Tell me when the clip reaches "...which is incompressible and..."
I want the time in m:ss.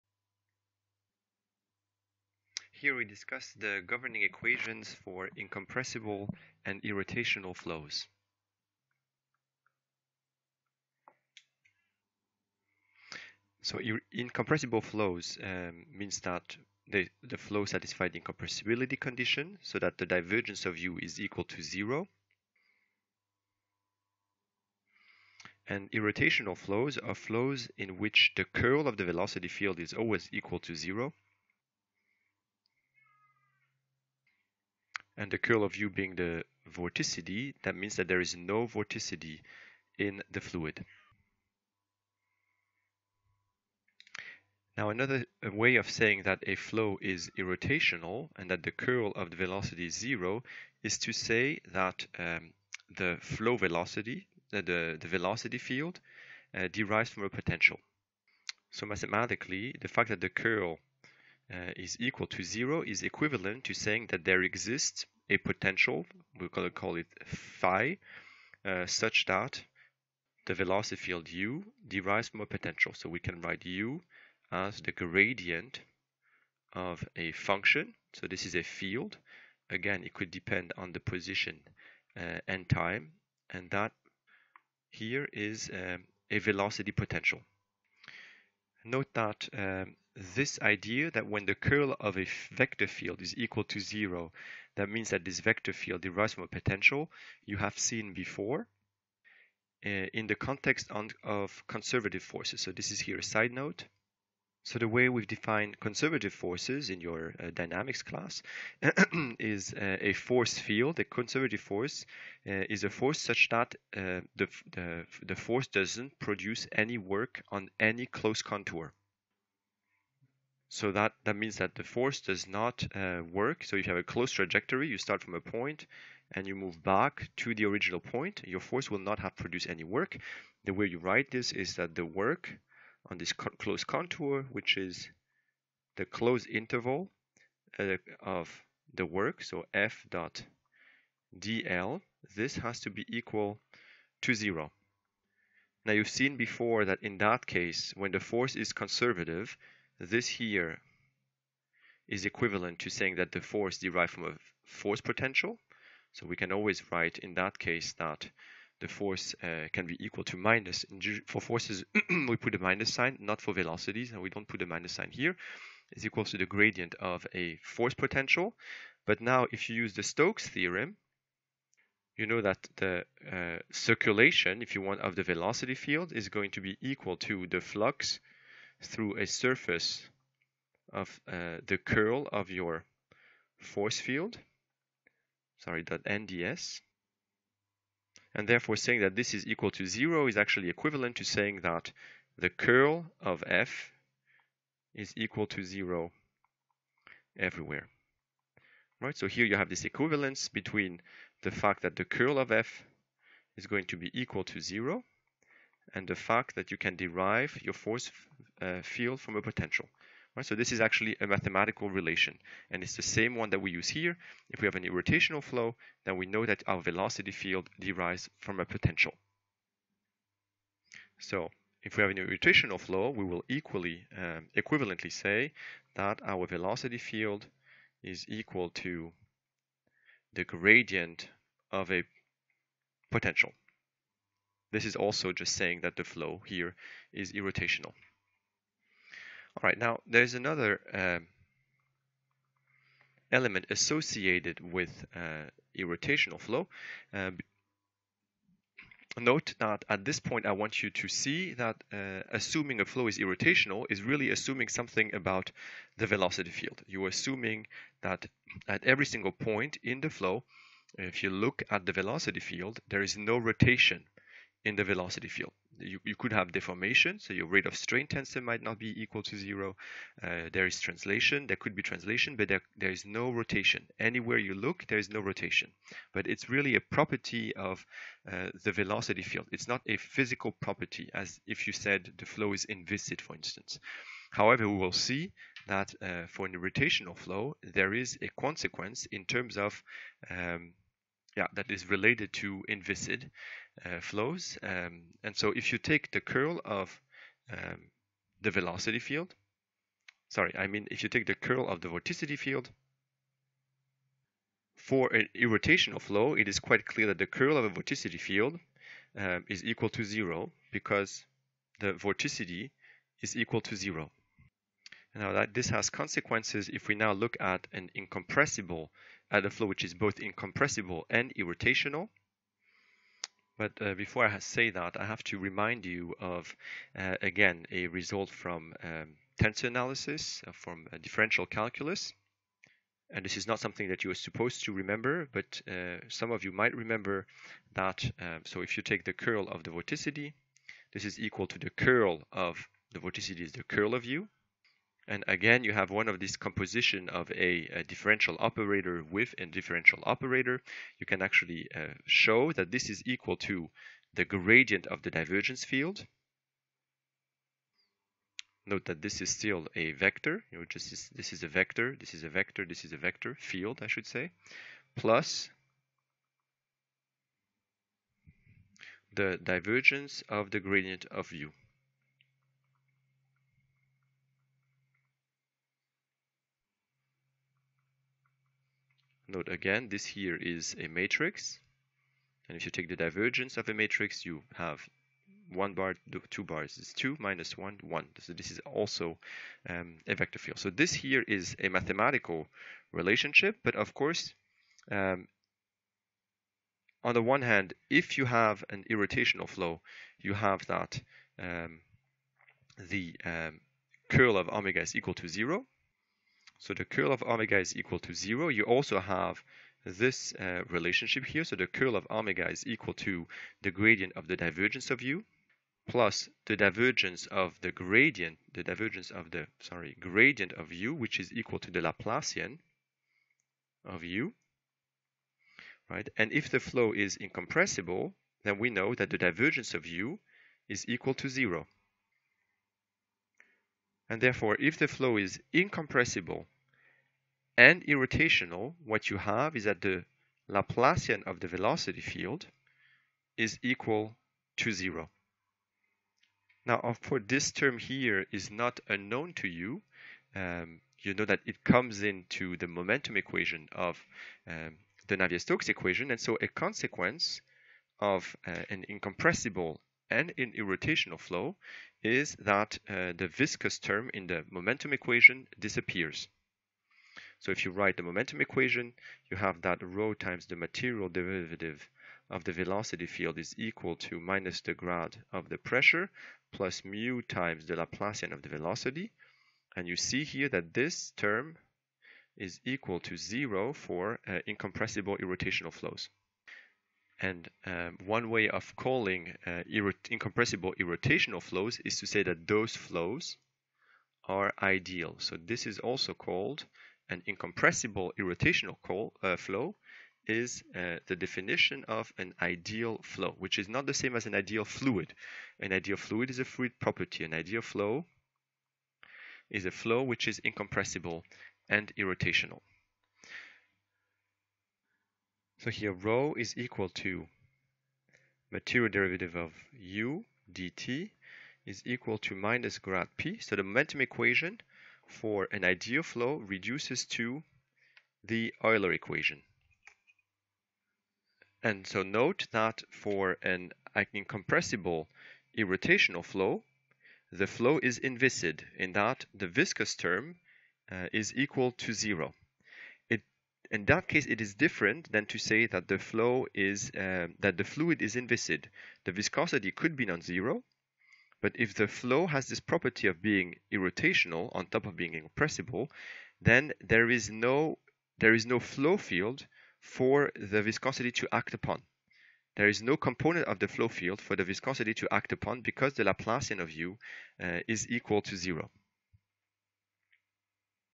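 8:30.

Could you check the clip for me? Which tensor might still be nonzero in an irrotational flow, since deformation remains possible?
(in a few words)
rate of strain tensor.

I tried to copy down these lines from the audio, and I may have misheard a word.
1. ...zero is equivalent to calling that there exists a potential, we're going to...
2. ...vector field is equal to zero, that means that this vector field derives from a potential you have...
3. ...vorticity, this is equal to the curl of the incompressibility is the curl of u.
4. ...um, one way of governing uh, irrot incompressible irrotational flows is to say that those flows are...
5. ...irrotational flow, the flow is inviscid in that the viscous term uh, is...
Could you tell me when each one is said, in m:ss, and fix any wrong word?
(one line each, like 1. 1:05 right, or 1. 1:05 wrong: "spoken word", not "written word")
1. 1:02 wrong: "saying", not "calling"
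2. 1:32 right
3. 5:39 wrong: "vorticity", not "incompressibility"
4. 8:07 wrong: "calling", not "governing"
5. 8:55 right.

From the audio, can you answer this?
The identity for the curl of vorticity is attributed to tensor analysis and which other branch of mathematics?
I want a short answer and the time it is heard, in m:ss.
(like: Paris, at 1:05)
differential calculus, at 5:30.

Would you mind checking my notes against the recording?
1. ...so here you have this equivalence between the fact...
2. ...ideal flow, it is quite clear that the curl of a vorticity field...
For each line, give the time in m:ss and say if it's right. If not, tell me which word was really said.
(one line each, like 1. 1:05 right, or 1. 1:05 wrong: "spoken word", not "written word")
1. 3:19 right
2. 5:05 wrong: "irrotational", not "ideal".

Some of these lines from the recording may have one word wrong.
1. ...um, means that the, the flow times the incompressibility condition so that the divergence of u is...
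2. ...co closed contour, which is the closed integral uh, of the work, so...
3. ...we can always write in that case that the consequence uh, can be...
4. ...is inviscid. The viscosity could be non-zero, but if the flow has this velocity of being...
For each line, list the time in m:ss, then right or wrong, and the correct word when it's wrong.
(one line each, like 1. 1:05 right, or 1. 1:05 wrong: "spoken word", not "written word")
1. 0:15 wrong: "satisfies", not "times"
2. 2:13 right
3. 2:36 wrong: "force", not "consequence"
4. 9:08 wrong: "property", not "velocity".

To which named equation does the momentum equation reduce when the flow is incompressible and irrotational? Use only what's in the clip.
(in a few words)
Euler equation.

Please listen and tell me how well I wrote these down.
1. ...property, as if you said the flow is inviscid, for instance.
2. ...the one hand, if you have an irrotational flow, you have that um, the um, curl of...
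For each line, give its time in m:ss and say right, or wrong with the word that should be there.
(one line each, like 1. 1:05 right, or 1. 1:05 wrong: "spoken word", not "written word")
1. 4:40 right
2. 6:37 right.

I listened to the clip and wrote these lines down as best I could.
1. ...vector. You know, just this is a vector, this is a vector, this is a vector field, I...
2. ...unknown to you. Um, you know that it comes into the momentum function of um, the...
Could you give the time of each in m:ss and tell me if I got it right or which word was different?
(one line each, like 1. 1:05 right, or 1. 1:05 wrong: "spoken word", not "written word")
1. 5:59 right
2. 7:28 wrong: "equation", not "function".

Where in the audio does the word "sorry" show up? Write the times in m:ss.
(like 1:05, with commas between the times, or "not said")
3:05, 5:00, 6:59.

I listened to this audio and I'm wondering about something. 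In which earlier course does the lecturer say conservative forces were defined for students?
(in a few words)
dynamics class.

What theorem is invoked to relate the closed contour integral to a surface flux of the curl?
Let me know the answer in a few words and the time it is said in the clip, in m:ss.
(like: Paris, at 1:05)
Stokes theorem, at 2:50.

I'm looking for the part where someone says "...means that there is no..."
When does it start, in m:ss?
0:37.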